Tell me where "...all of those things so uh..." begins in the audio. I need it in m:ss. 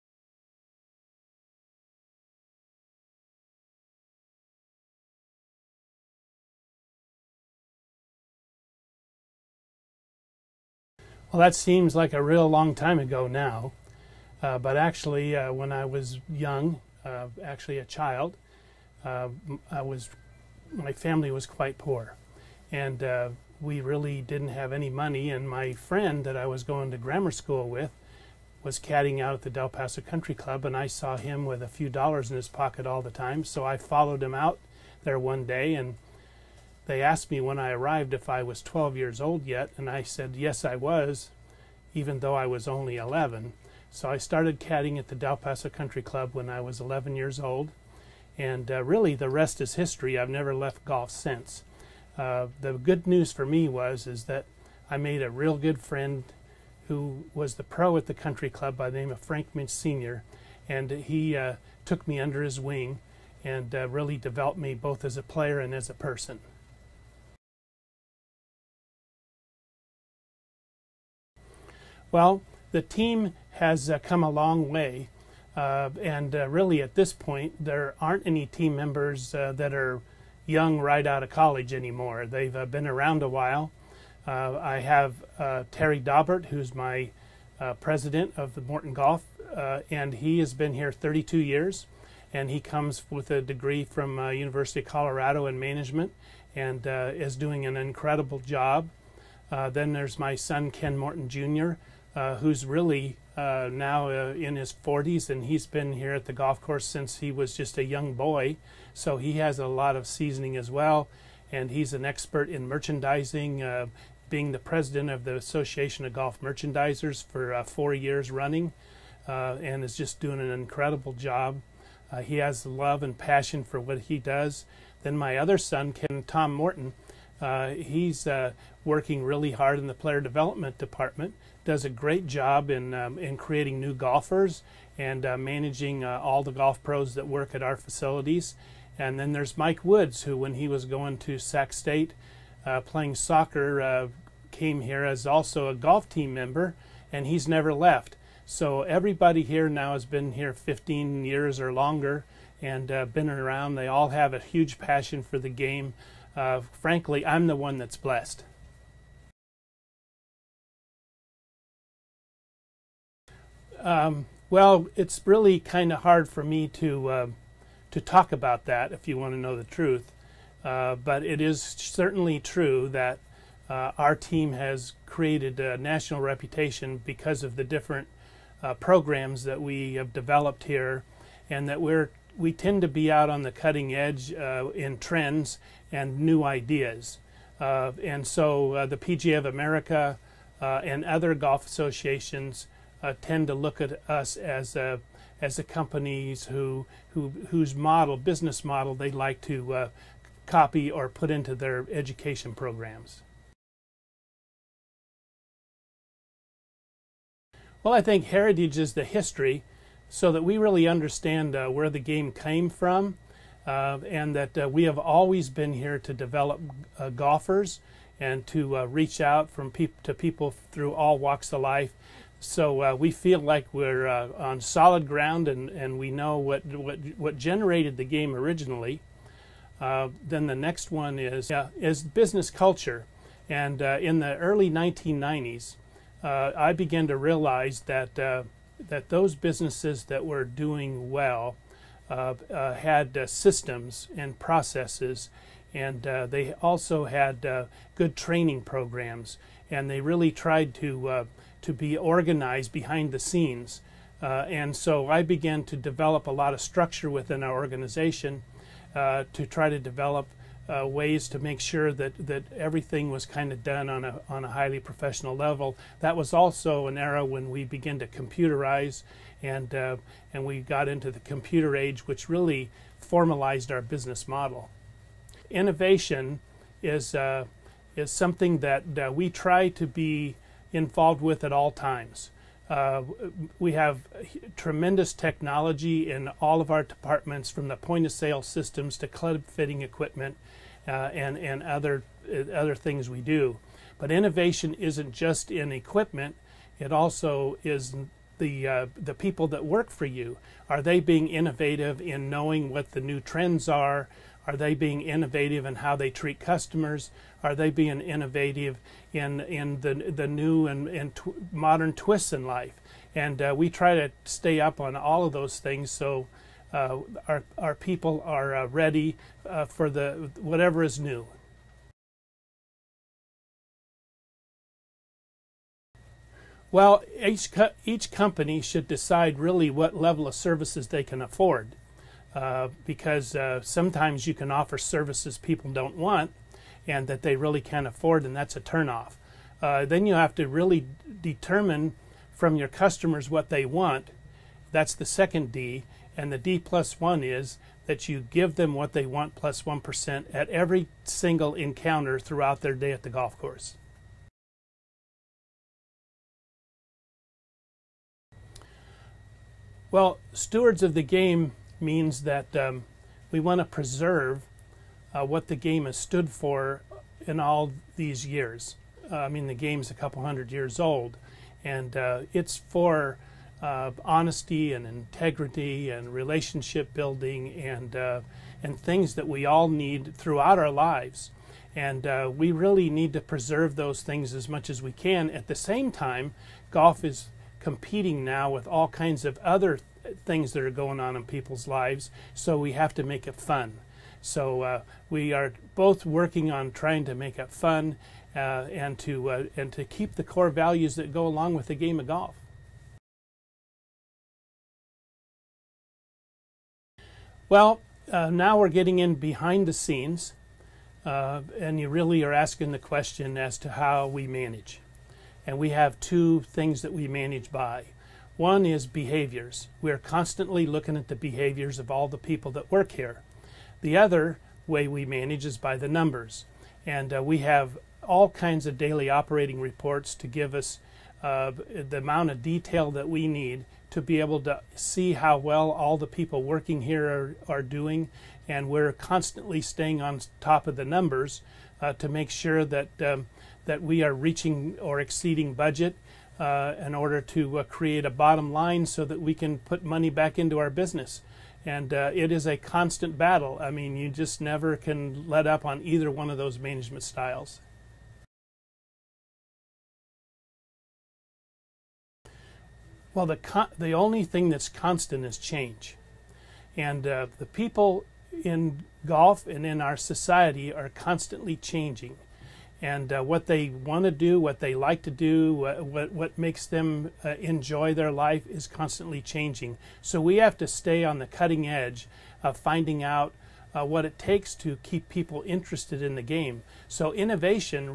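5:14.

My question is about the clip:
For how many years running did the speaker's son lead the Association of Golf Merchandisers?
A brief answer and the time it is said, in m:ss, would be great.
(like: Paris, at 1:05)
4, at 1:57.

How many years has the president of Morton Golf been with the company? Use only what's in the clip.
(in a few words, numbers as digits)
32.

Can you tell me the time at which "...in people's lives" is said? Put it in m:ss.
6:31.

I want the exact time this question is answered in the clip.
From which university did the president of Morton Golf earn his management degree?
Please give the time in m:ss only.
1:34.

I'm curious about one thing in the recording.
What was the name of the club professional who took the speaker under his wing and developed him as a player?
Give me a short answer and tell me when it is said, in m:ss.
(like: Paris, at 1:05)
Frank Minch Sr., at 0:59.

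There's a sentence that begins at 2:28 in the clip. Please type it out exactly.
So everybody here now has been here 15 years or longer and uh, been around.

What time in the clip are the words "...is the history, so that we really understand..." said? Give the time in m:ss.
3:28.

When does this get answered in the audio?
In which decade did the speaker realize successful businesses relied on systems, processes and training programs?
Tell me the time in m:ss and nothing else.
3:54.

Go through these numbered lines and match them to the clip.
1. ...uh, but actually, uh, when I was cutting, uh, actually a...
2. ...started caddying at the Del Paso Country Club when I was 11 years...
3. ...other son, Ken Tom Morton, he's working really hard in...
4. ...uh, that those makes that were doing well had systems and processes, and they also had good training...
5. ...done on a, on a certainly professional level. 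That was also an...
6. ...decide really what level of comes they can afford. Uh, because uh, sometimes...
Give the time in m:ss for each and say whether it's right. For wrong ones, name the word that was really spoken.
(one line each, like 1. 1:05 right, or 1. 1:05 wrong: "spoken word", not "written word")
1. 0:14 wrong: "young", not "cutting"
2. 0:44 right
3. 2:05 right
4. 3:58 wrong: "businesses", not "makes"
5. 4:23 wrong: "highly", not "certainly"
6. 5:28 wrong: "services", not "comes".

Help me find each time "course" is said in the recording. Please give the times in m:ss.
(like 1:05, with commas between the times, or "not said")
1:46, 5:53.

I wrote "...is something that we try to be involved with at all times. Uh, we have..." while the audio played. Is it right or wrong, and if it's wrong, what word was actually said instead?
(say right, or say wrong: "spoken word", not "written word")
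right.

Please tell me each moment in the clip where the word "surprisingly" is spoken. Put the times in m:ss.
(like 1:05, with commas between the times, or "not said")
not said.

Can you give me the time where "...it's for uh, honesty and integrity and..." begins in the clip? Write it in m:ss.
6:12.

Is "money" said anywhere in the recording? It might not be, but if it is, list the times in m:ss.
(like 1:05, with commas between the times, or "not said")
0:24, 7:29.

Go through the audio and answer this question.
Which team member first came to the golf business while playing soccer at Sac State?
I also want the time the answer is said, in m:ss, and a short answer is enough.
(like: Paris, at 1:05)
Mike Woods, at 2:19.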